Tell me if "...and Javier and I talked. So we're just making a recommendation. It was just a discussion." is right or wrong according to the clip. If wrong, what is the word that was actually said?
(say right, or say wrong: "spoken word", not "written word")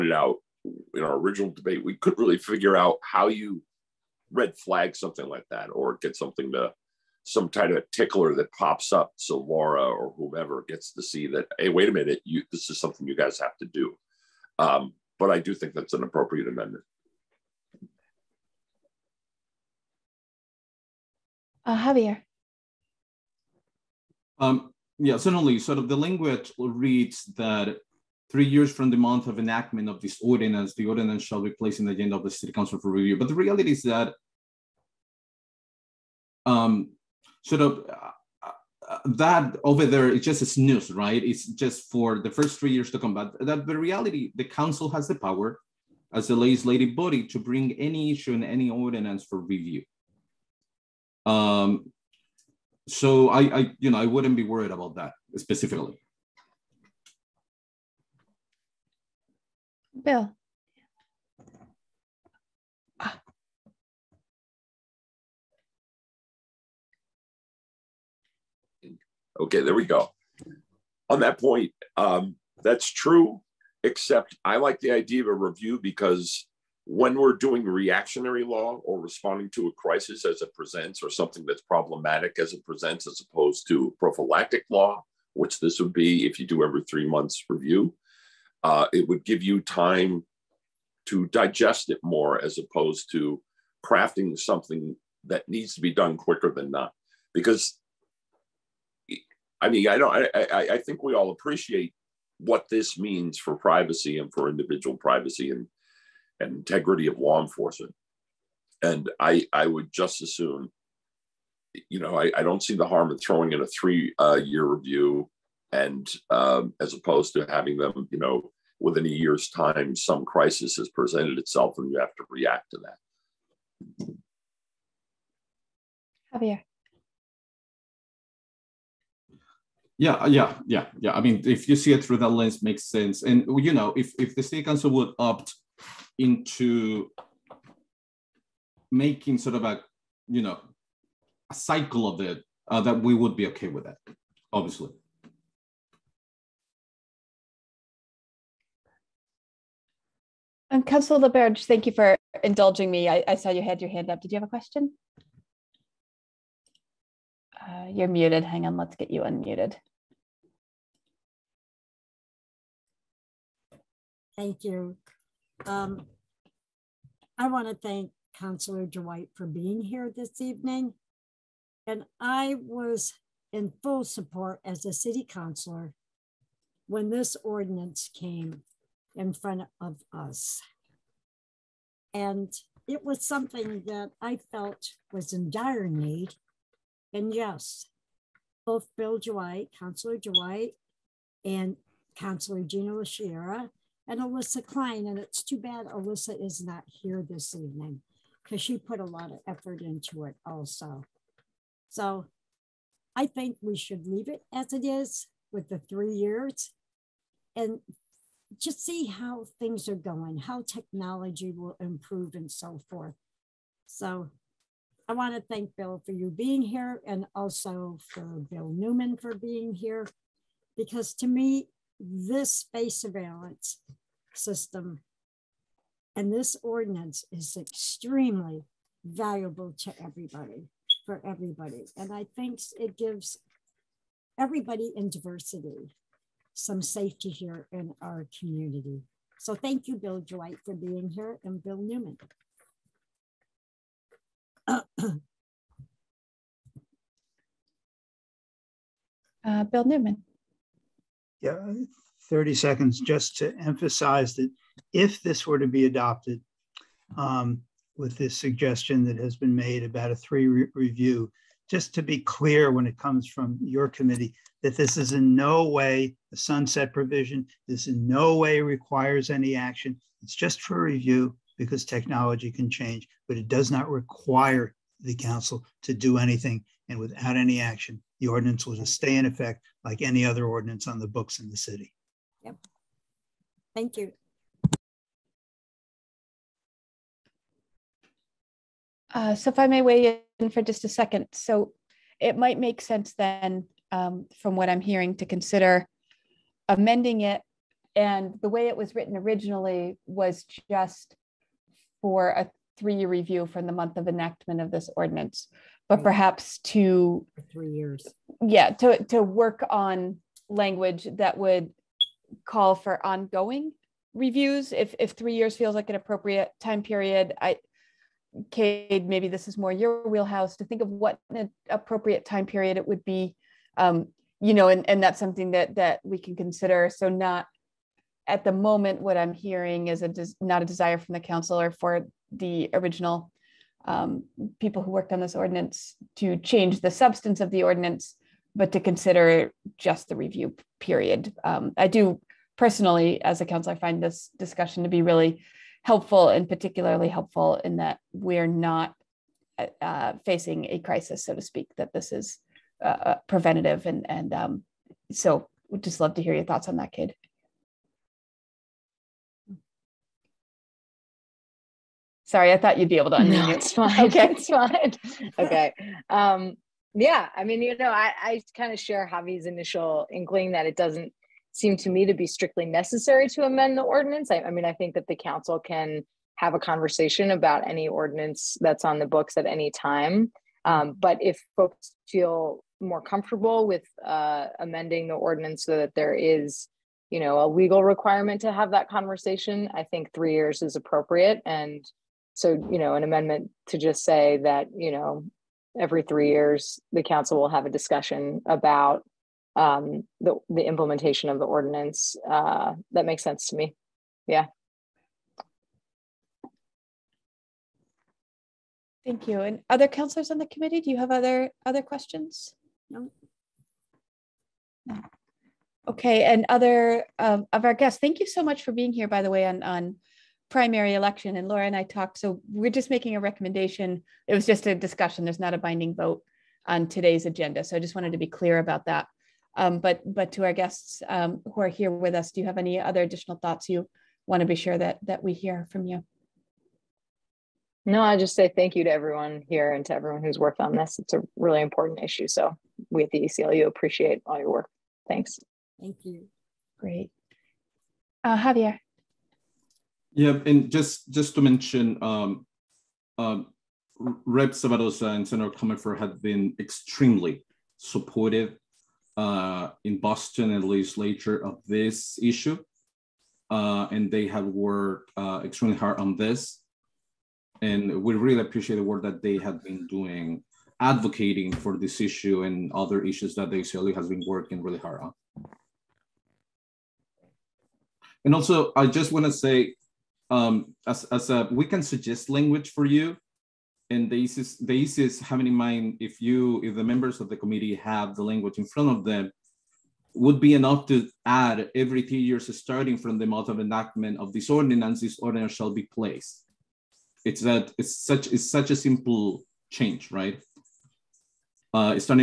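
wrong: "Laura", not "Javier".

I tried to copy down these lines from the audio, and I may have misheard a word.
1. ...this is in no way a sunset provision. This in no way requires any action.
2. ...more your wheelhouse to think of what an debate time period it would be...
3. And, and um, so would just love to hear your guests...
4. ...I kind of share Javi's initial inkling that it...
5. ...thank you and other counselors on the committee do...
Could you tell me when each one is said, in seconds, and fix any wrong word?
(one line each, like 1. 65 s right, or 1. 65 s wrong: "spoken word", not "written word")
1. 264 s right
2. 319 s wrong: "appropriate", not "debate"
3. 353 s wrong: "thoughts", not "guests"
4. 368 s right
5. 409 s right.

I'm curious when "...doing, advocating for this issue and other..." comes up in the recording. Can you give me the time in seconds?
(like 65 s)
469 s.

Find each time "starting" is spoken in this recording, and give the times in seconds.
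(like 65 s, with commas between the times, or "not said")
492 s.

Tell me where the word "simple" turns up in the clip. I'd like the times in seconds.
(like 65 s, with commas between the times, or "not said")
498 s.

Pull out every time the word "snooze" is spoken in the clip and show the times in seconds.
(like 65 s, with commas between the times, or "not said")
40 s.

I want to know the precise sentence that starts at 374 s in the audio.
I, I mean, I think that the council can have a conversation about any ordinance that's on the books at any time.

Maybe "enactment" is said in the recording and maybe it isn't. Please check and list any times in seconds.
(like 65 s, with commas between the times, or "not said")
29 s, 304 s, 493 s.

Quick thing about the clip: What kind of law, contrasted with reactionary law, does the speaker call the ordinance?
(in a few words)
prophylactic law.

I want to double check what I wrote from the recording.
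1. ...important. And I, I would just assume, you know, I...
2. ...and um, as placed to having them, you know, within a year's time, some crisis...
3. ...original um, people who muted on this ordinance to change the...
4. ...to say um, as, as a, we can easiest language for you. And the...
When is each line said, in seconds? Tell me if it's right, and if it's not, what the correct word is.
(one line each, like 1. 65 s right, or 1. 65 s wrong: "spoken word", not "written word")
1. 107 s wrong: "enforcement", not "important"
2. 115 s wrong: "opposed", not "placed"
3. 332 s wrong: "worked", not "muted"
4. 479 s wrong: "suggest", not "easiest".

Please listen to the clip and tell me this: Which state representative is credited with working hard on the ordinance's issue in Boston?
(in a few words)
Rep. Sabadosa.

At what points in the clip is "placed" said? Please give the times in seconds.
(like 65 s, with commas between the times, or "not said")
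31 s, 495 s.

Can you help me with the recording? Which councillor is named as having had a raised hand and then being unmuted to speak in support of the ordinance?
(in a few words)
Councillor LaBarge.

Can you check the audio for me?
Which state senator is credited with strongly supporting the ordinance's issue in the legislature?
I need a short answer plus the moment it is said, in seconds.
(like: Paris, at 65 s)
Senator Comerford, at 455 s.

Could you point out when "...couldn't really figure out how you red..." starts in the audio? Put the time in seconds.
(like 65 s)
1 s.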